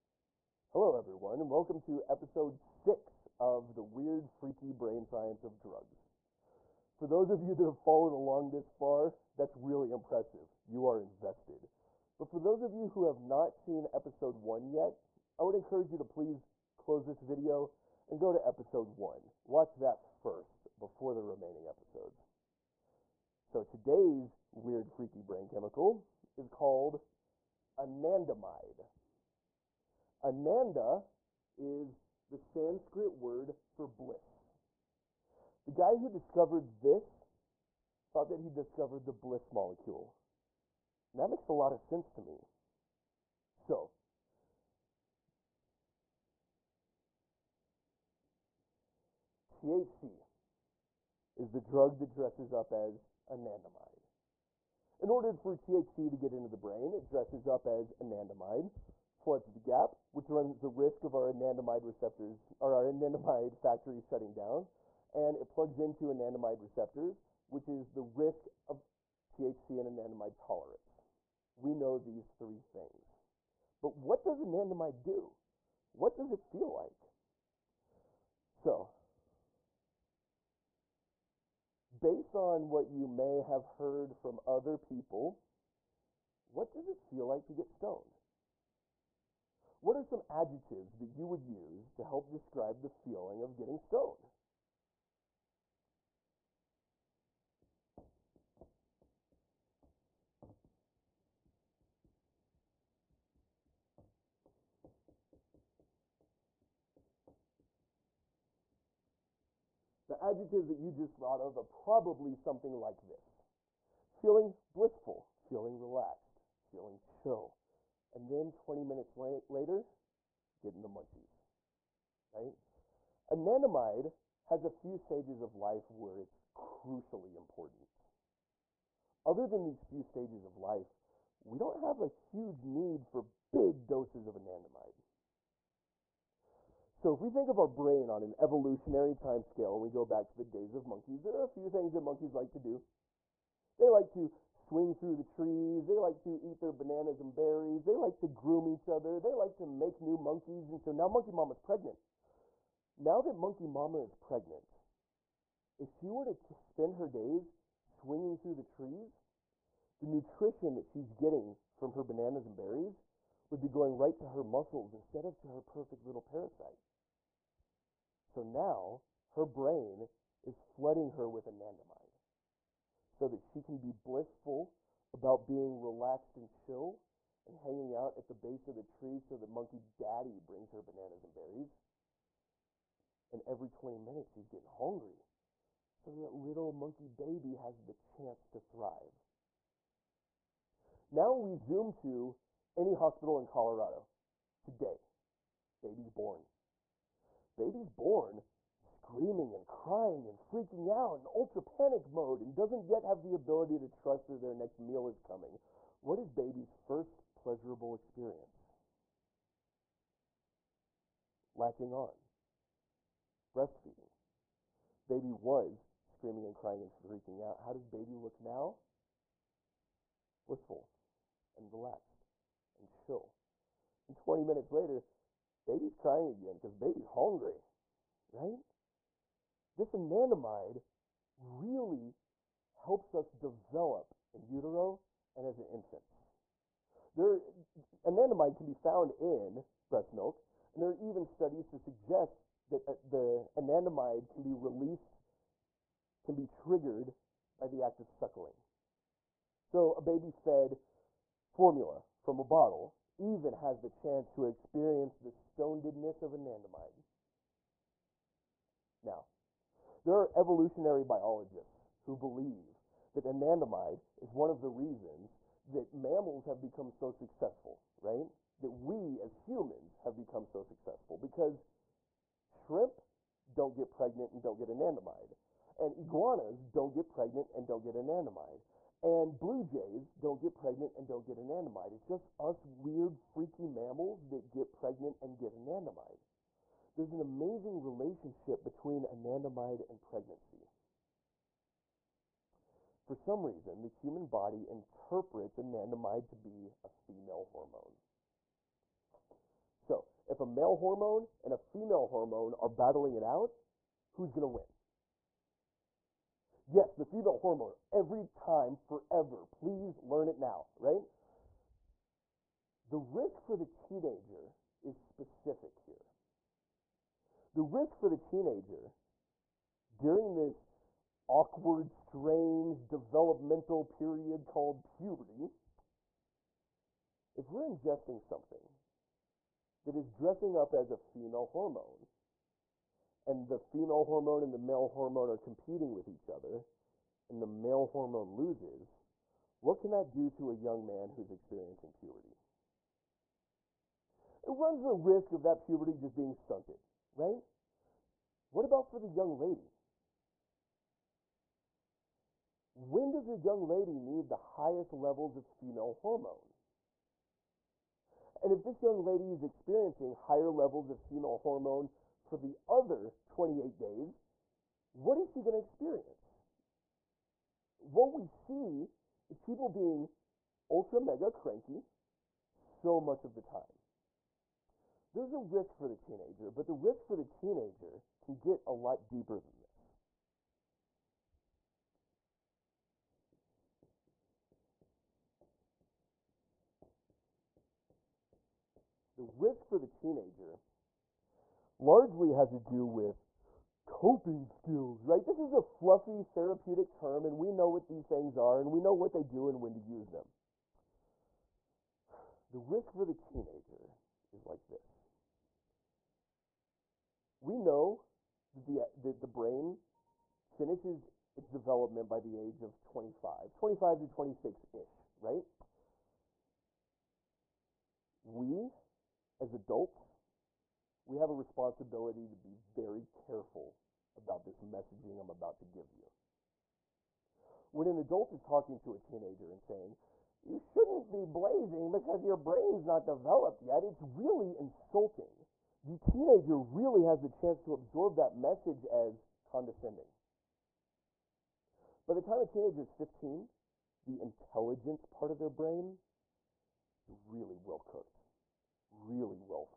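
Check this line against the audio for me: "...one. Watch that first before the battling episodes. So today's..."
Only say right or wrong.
wrong.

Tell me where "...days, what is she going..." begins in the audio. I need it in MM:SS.
06:03.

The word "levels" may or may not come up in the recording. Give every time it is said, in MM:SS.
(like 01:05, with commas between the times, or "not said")
05:54, 06:00.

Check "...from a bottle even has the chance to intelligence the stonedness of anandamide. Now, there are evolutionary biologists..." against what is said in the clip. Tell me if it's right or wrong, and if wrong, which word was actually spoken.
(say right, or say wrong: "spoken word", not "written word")
wrong: "experience", not "intelligence".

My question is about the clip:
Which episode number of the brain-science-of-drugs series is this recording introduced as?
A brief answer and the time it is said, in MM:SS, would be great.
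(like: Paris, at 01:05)
6, at 00:02.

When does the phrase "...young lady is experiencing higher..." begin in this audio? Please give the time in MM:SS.
05:58.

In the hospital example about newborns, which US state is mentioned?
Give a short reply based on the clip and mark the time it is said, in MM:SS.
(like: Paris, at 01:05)
Colorado, at 03:13.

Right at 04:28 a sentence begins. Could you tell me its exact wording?
That we as humans have become so successful because shrimp don't get pregnant and don't get anandamide.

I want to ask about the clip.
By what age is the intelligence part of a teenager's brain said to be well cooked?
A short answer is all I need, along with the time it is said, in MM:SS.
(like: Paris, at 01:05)
15, at 07:22.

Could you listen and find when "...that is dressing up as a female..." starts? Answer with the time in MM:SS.
05:29.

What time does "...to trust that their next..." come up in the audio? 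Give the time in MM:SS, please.
03:23.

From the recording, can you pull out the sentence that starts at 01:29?
What are some adjectives that you would use to help describe the feeling of getting stoned?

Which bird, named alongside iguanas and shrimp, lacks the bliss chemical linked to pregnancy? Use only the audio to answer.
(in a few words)
blue jays.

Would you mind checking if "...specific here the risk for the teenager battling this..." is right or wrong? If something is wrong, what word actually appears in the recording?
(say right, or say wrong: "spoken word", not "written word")
wrong: "during", not "battling".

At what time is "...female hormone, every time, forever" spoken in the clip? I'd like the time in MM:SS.
05:07.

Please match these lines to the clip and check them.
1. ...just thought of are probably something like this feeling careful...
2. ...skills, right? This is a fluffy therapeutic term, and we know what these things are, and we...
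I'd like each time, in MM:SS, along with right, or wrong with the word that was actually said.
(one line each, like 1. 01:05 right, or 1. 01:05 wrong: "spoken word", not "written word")
1. 01:50 wrong: "blissful", not "careful"
2. 06:34 right.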